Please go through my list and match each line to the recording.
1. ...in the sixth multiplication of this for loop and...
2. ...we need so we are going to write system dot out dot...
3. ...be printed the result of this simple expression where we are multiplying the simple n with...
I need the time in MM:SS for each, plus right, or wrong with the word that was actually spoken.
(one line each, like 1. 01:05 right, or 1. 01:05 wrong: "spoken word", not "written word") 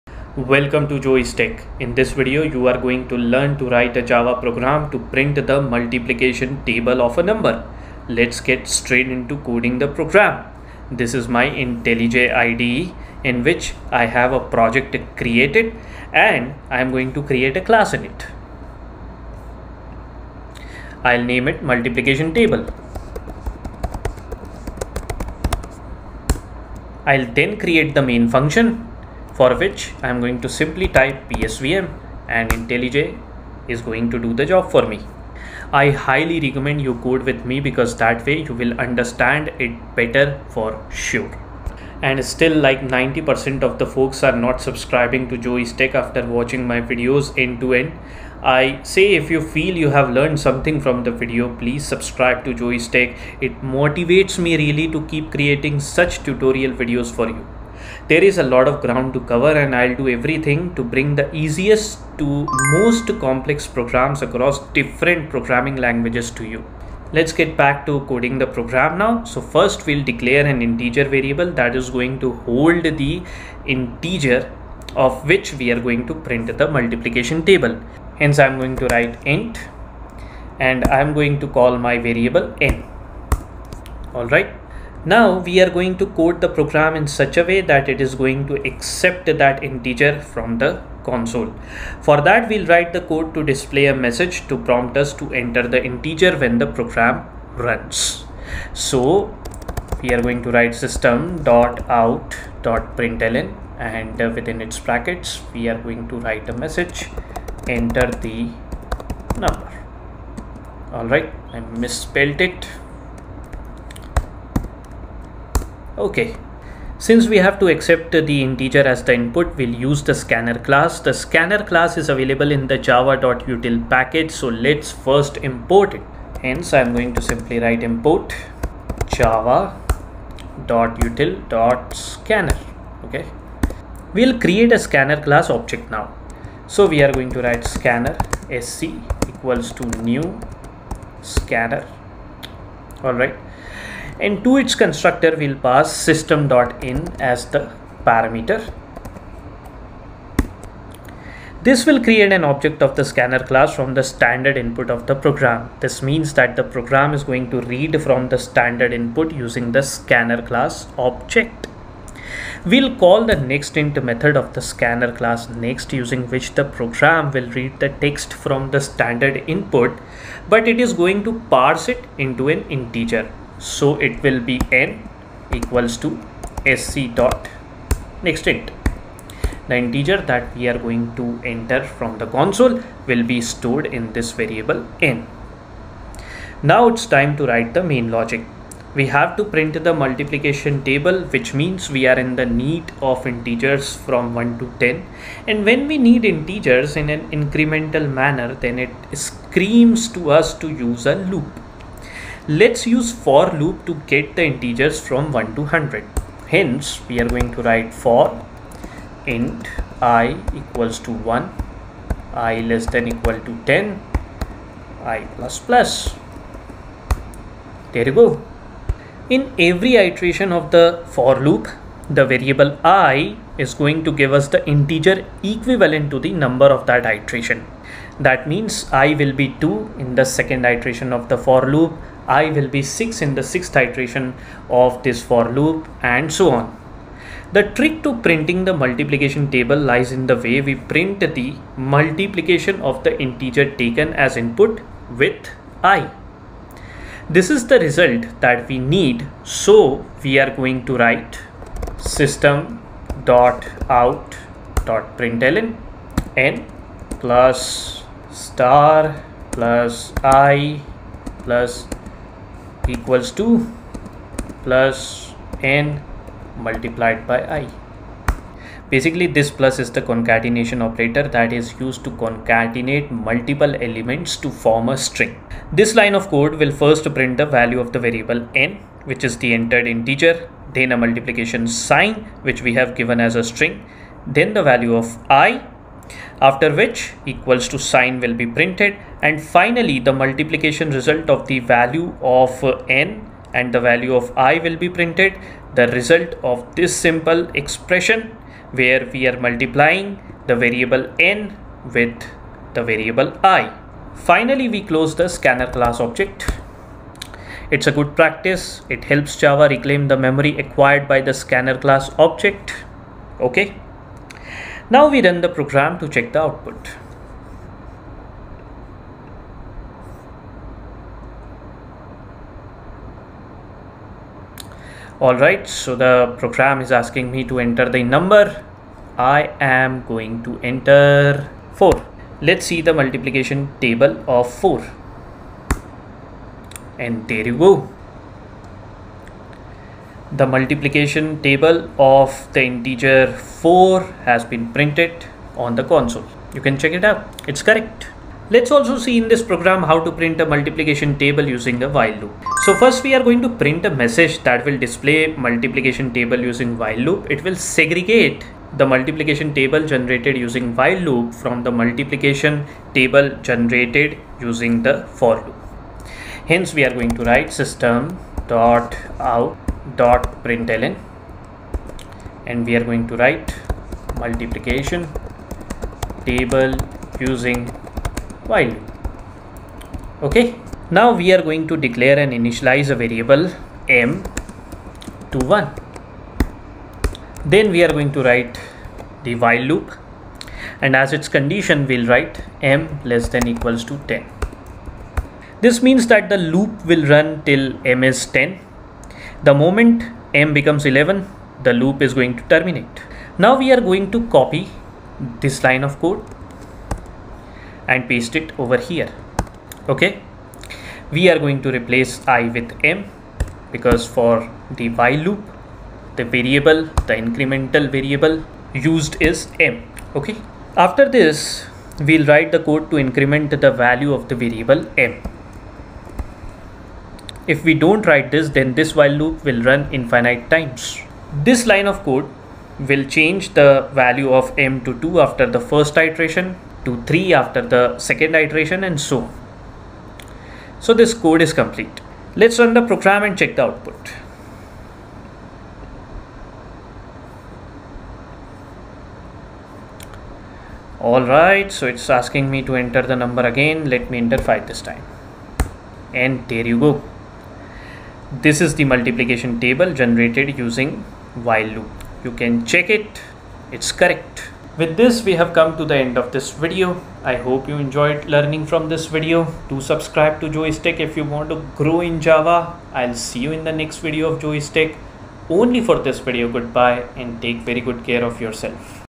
1. 03:53 wrong: "iteration", not "multiplication"
2. 04:08 right
3. 04:54 wrong: "variable", not "simple".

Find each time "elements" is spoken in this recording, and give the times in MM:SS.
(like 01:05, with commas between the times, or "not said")
04:33.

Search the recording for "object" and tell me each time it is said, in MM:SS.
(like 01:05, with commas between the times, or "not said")
02:15, 02:32, 02:40, 05:05, 05:12.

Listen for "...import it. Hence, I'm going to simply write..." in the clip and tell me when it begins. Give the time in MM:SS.
02:05.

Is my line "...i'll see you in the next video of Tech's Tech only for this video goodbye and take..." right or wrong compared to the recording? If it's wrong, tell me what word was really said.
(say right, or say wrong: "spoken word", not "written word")
wrong: "Joey", not "Tech".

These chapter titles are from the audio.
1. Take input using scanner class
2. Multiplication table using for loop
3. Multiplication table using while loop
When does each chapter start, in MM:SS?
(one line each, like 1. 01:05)
1. 01:24
2. 03:06
3. 05:48.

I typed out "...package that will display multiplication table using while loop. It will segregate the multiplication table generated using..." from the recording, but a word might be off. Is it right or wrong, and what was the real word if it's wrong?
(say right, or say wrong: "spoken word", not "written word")
wrong: "message", not "package".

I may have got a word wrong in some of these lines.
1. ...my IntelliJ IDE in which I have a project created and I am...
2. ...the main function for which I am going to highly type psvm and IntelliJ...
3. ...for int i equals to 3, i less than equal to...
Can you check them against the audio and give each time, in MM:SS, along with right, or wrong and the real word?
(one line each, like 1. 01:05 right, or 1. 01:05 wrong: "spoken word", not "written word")
1. 00:11 right
2. 00:27 wrong: "simply", not "highly"
3. 03:27 wrong: "1", not "3".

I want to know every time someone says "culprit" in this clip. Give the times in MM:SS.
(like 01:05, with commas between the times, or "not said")
not said.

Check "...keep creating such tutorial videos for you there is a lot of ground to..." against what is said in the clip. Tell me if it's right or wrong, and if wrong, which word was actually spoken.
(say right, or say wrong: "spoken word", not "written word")
right.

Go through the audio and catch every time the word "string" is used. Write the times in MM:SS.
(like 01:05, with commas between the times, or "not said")
04:34, 04:43.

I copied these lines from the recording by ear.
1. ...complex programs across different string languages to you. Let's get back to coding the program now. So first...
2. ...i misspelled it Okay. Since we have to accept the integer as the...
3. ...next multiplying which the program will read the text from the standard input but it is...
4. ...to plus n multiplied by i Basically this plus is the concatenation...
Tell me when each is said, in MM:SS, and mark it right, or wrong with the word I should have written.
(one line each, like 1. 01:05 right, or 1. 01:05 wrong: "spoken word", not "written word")
1. 01:03 wrong: "programming", not "string"
2. 01:51 right
3. 02:45 wrong: "using", not "multiplying"
4. 04:23 right.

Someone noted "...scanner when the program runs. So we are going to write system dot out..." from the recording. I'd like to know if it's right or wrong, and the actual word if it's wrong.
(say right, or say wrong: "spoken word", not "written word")
wrong: "integer", not "scanner".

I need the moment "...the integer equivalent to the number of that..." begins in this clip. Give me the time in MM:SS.
03:44.